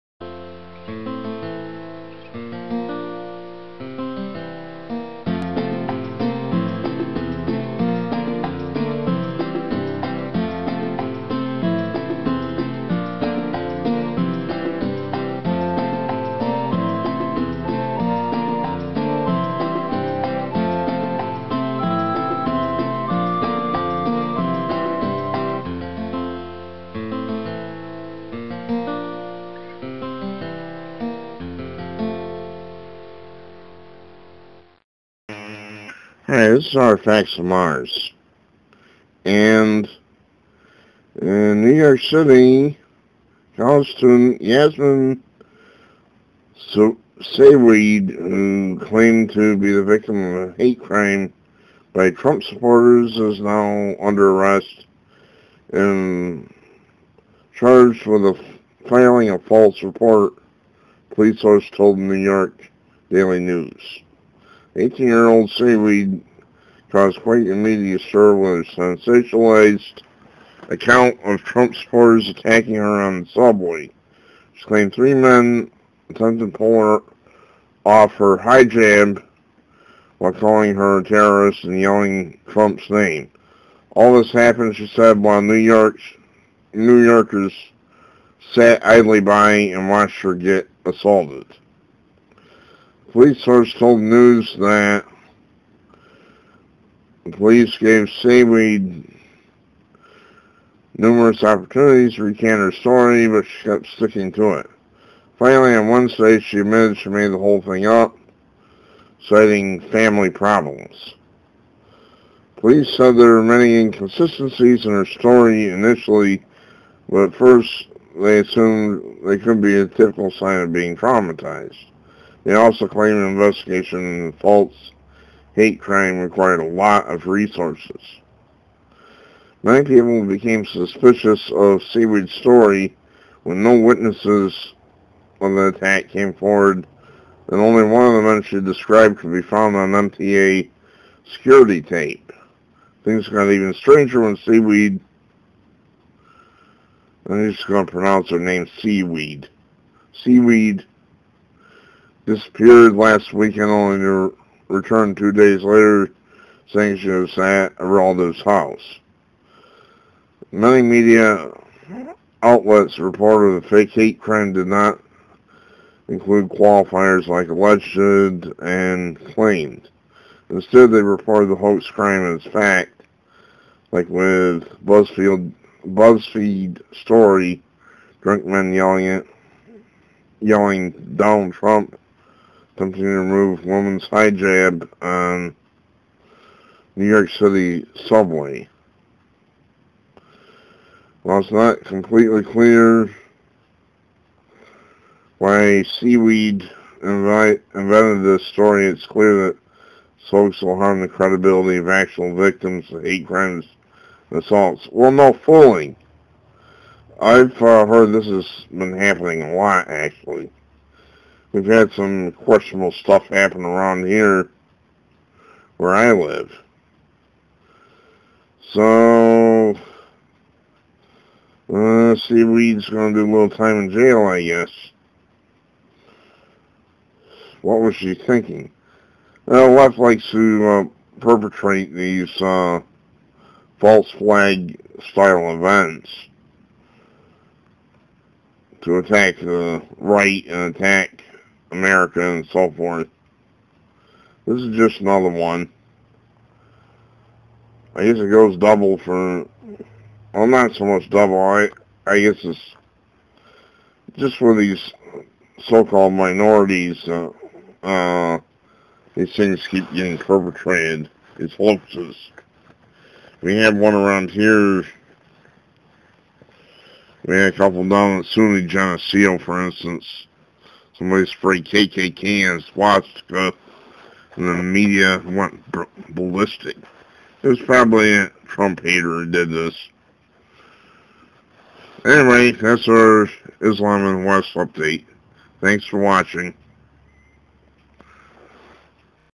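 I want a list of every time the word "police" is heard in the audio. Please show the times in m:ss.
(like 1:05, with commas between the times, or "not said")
1:01, 1:33, 1:37, 1:52.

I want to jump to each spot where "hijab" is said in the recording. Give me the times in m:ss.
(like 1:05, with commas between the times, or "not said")
1:18, 3:04.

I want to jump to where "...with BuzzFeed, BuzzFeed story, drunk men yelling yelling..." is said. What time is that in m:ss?
2:54.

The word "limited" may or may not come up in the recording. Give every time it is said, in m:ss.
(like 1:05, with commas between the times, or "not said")
not said.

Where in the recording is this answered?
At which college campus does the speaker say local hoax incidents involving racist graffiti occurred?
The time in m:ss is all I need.
4:28.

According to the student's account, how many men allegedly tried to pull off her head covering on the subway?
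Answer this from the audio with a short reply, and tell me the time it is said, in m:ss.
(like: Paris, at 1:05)
3, at 1:14.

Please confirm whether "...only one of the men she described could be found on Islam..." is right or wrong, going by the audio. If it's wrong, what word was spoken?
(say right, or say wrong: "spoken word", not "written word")
wrong: "MTA", not "Islam".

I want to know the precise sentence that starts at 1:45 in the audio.
Finally, on Wednesday, she admitted she made the whole thing up, citing family problems.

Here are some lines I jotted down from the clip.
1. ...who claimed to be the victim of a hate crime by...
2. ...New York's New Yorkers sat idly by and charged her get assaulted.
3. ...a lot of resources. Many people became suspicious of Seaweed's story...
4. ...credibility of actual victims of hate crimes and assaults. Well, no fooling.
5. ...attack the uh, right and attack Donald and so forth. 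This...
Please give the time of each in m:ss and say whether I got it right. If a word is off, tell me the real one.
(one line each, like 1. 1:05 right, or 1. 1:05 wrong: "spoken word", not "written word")
1. 0:47 right
2. 1:25 wrong: "watched", not "charged"
3. 2:06 right
4. 3:21 right
5. 3:58 wrong: "America", not "Donald".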